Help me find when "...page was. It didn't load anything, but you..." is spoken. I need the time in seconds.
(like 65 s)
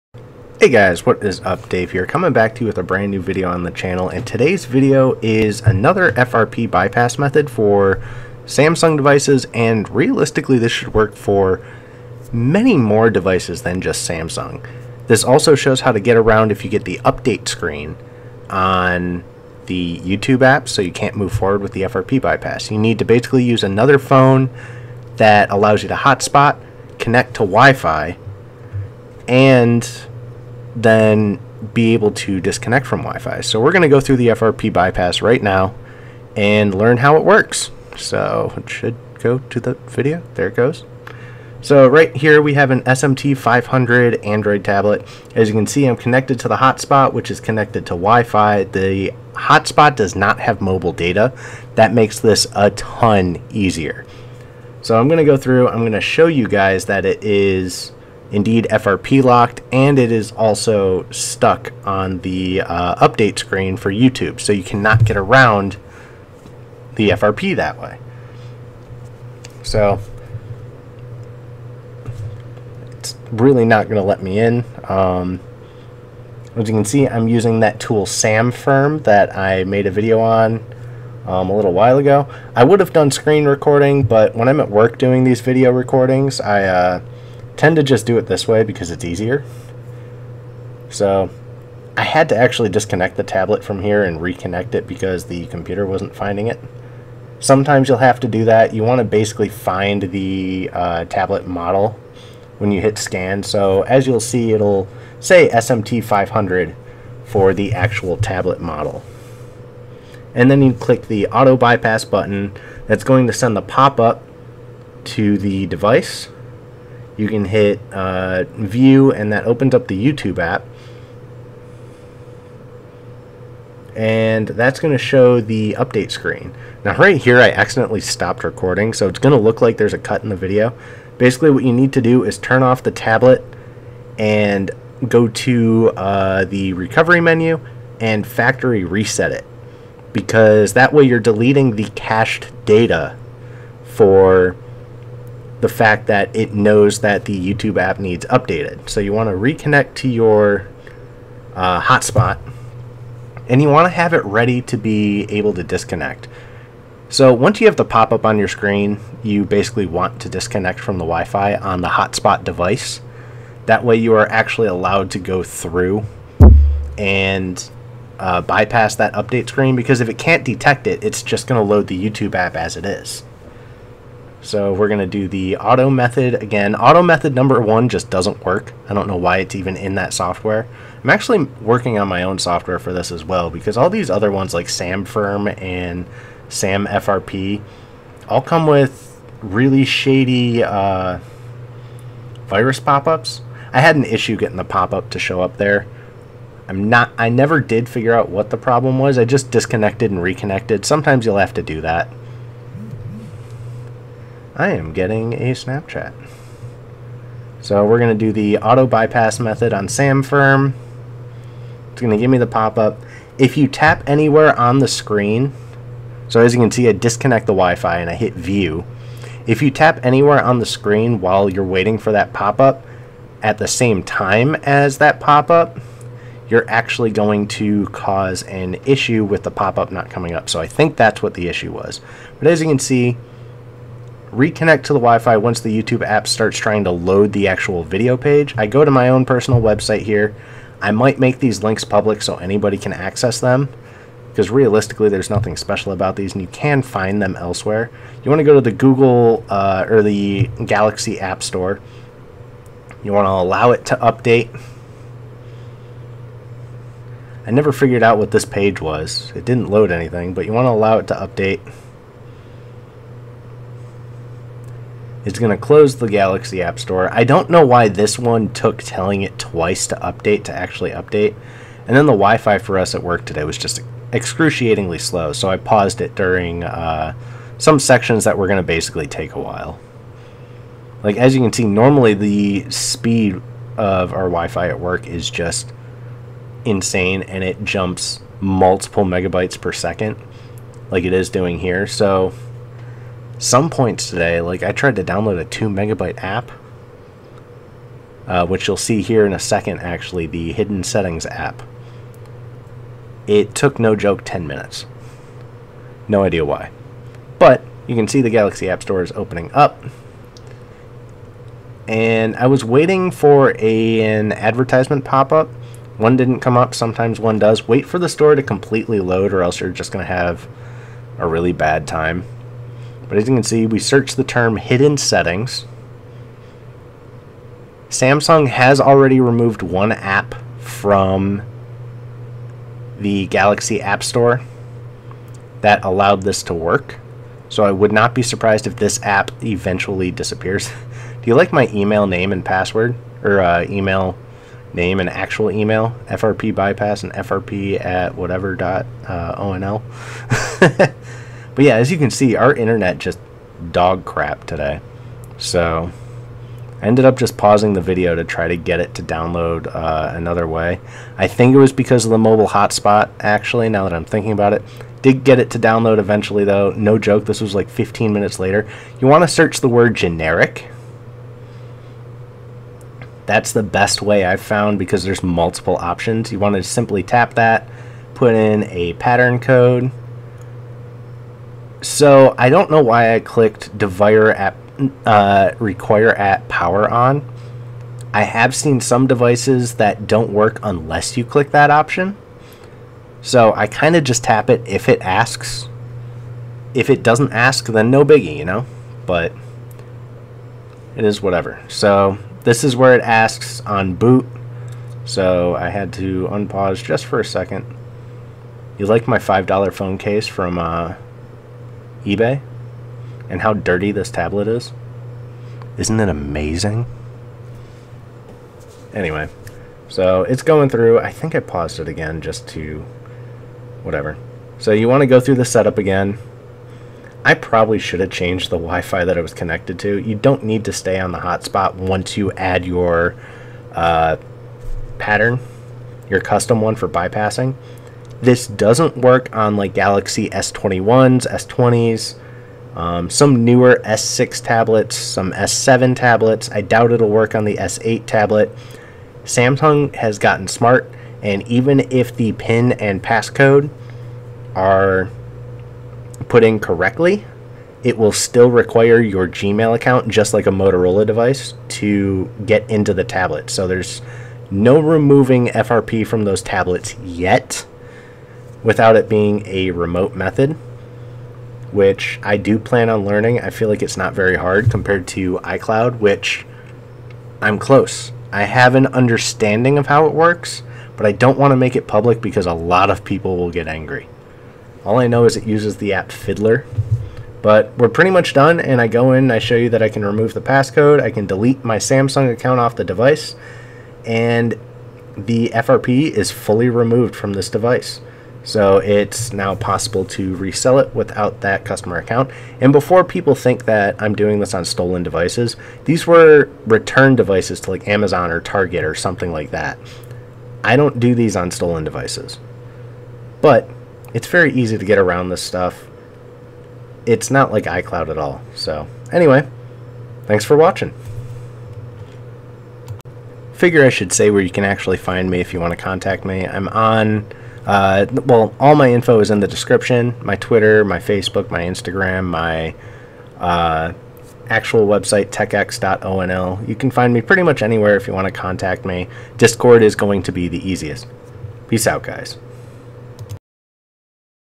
258 s.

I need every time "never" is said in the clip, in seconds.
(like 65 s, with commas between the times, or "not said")
197 s, 257 s.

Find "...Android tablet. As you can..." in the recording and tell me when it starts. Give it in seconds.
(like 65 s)
44 s.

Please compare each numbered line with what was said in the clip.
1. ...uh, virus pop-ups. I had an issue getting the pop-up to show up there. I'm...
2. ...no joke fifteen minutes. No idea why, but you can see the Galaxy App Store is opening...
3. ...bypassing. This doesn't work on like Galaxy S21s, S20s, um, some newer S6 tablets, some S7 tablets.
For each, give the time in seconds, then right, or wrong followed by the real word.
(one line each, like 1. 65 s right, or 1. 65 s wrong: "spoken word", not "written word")
1. 190 s right
2. 303 s wrong: "ten", not "fifteen"
3. 436 s right.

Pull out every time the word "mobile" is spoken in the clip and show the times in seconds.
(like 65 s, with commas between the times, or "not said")
50 s, 362 s.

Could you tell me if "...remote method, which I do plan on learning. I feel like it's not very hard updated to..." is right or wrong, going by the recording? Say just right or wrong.
wrong.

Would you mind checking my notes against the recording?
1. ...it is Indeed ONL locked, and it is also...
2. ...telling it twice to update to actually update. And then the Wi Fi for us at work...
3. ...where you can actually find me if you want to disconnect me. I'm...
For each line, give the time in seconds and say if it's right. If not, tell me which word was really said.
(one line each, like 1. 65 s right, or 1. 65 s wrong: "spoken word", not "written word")
1. 57 s wrong: "FRP", not "ONL"
2. 268 s right
3. 524 s wrong: "contact", not "disconnect".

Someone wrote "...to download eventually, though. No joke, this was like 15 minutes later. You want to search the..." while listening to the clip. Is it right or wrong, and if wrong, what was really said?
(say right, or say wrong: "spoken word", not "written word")
right.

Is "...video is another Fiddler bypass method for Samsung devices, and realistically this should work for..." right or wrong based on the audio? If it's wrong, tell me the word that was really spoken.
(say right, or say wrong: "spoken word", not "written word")
wrong: "FRP", not "Fiddler".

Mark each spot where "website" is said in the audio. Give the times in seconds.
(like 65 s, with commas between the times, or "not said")
239 s, 534 s.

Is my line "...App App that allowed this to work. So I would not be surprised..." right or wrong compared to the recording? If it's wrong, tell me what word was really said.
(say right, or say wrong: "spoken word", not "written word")
wrong: "Store", not "App".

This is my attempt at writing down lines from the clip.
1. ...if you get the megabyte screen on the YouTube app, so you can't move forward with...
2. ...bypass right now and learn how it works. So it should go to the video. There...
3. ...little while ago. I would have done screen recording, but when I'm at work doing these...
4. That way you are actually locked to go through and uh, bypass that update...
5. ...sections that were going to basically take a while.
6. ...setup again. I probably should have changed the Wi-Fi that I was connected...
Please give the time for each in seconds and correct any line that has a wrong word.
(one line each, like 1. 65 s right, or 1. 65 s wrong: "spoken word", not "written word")
1. 16 s wrong: "update", not "megabyte"
2. 34 s right
3. 81 s right
4. 163 s wrong: "allowed", not "locked"
5. 277 s right
6. 425 s right.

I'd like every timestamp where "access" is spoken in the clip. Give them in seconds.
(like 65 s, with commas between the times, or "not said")
242 s.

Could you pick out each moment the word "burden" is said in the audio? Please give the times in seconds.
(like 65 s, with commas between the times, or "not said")
not said.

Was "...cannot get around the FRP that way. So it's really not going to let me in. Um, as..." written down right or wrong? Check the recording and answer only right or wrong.
right.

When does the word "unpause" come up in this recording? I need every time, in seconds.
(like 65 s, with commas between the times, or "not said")
406 s.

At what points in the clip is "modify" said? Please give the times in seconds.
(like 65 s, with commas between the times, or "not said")
not said.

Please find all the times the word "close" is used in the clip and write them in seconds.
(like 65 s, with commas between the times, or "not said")
265 s, 477 s.